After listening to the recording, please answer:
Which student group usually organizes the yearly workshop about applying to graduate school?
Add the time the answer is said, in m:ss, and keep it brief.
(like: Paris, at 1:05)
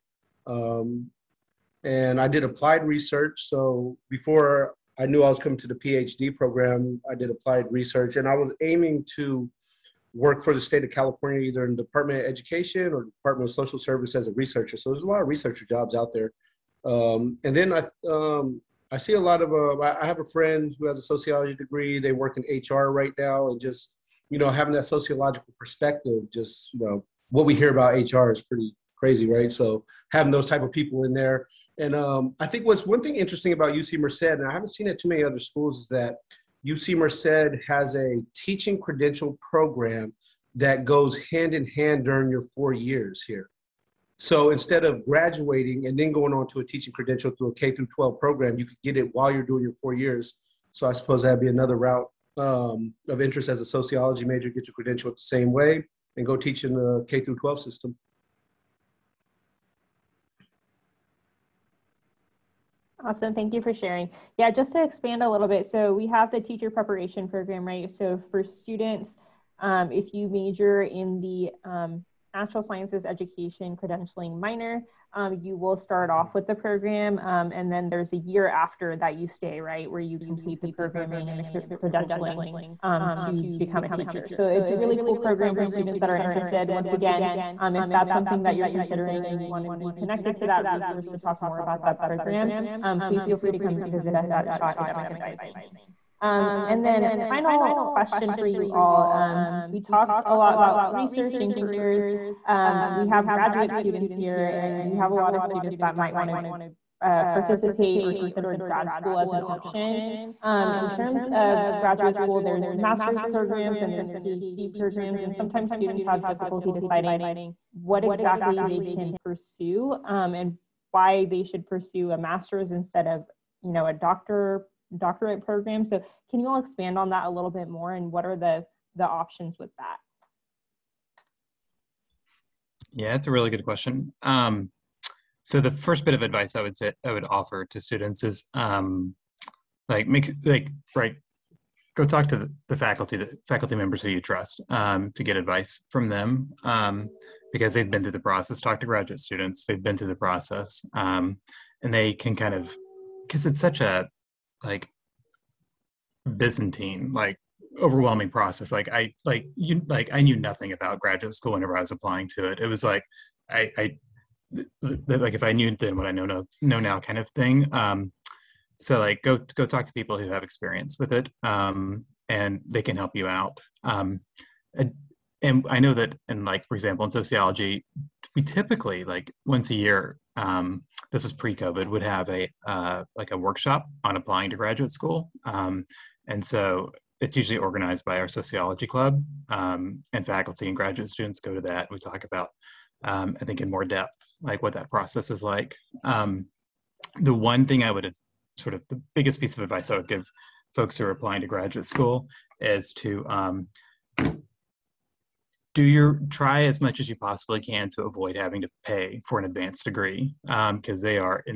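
sociology club, at 3:08.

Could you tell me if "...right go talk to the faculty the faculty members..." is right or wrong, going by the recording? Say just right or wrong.
right.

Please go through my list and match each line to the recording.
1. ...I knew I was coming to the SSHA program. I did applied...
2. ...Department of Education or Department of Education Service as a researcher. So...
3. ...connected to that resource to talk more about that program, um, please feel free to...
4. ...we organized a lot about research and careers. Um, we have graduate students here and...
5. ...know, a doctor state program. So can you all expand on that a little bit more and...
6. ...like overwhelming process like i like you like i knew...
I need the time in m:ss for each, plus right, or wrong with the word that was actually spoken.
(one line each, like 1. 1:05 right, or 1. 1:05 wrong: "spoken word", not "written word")
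1. 0:04 wrong: "PhD", not "SSHA"
2. 0:11 wrong: "Social", not "Education"
3. 1:29 right
4. 1:39 wrong: "talked", not "organized"
5. 2:03 wrong: "doctorate", not "state"
6. 2:37 right.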